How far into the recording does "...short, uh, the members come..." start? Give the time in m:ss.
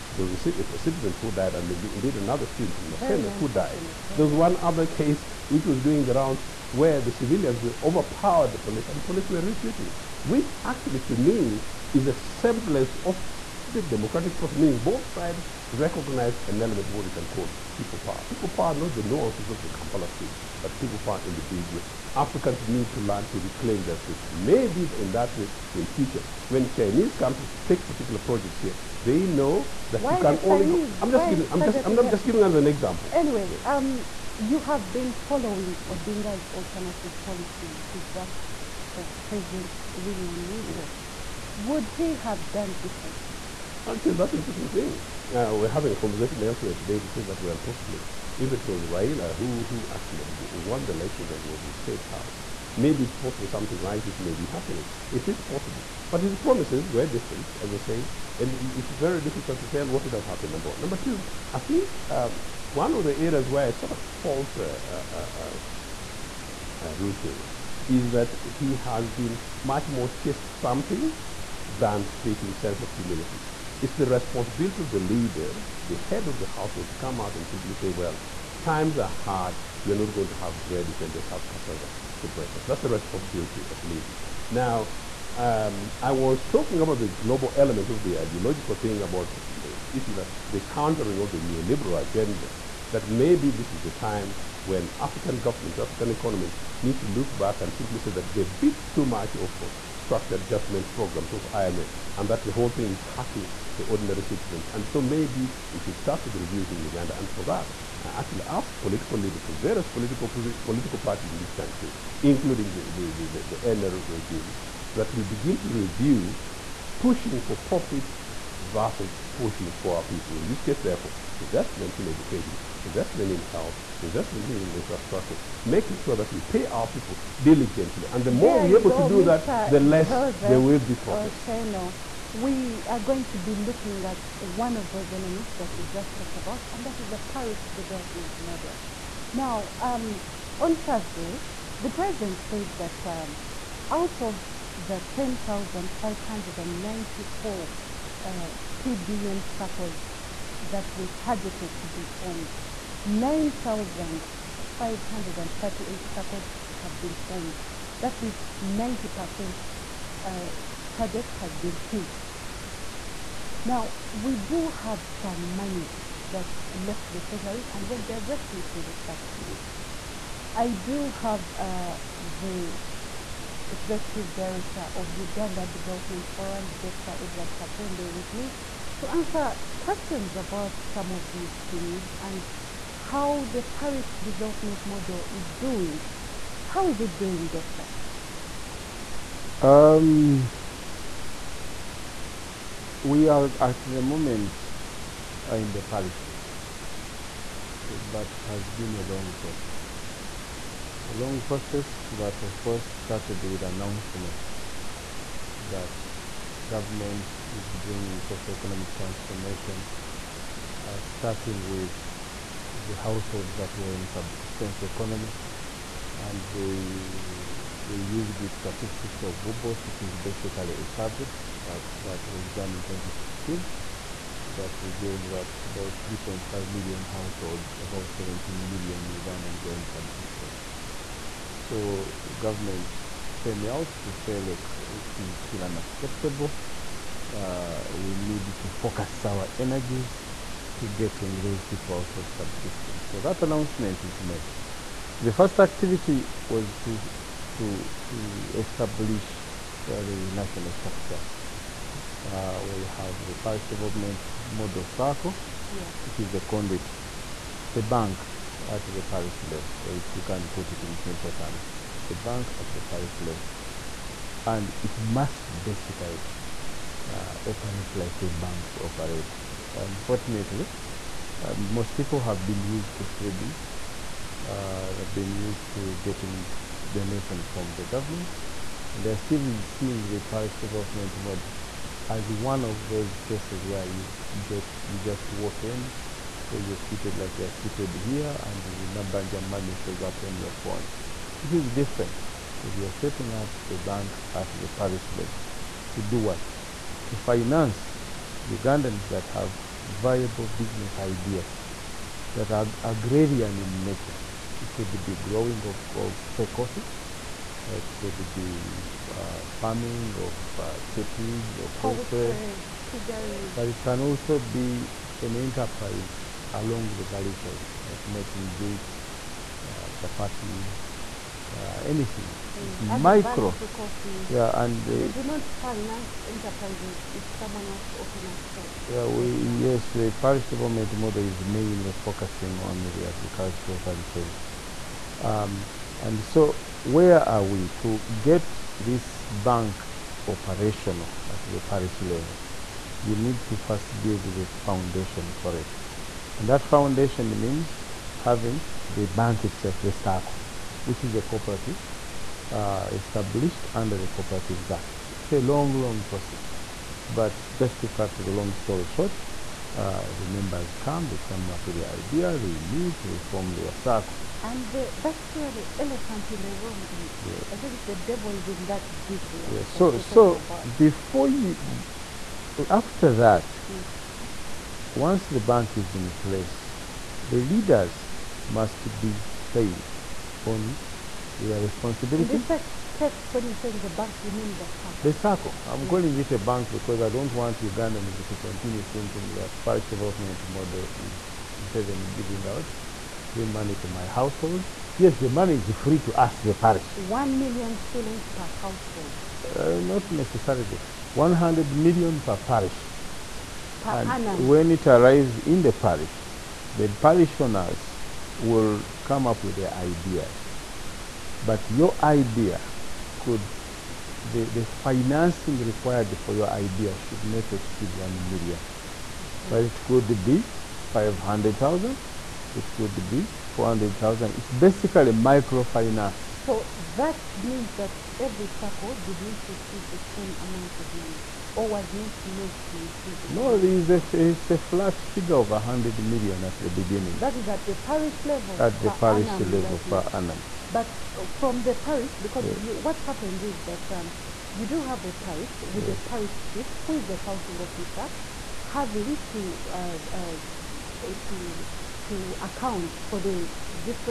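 5:58.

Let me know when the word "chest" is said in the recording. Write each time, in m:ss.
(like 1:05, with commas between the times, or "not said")
1:10.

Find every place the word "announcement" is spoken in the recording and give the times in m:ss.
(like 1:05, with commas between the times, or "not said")
3:23, 4:03.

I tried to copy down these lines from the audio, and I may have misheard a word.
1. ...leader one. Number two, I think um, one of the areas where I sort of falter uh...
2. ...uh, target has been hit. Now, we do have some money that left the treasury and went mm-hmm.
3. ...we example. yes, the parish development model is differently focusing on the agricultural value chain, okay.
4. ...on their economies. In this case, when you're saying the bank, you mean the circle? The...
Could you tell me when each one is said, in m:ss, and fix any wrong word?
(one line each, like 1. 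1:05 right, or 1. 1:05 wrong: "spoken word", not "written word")
1. 1:00 wrong: "number", not "leader"
2. 2:40 right
3. 5:29 wrong: "mainly", not "differently"
4. 6:20 wrong: "responsibilities", not "economies".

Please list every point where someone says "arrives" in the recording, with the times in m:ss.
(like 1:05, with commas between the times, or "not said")
6:44.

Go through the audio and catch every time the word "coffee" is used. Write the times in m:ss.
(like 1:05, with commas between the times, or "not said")
5:06, 5:23.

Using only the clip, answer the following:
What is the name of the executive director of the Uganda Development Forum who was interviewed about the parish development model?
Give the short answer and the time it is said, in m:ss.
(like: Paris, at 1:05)
Edward Katende, at 2:57.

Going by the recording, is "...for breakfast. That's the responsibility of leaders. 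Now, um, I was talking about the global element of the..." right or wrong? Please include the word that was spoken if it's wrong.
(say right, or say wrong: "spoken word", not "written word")
right.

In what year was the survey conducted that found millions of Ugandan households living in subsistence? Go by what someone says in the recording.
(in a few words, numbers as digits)
2016.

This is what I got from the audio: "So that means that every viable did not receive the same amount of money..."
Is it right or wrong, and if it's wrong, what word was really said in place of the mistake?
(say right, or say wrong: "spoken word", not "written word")
wrong: "circle", not "viable".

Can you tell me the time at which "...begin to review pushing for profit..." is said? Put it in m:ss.
1:55.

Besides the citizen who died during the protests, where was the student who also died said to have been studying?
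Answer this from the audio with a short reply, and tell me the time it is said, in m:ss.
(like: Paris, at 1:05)
Maseno, at 0:02.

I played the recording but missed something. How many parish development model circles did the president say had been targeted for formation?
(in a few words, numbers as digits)
10,594.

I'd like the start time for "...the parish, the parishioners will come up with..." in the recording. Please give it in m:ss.
6:45.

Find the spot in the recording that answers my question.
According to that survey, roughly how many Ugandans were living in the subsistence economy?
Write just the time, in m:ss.
3:48.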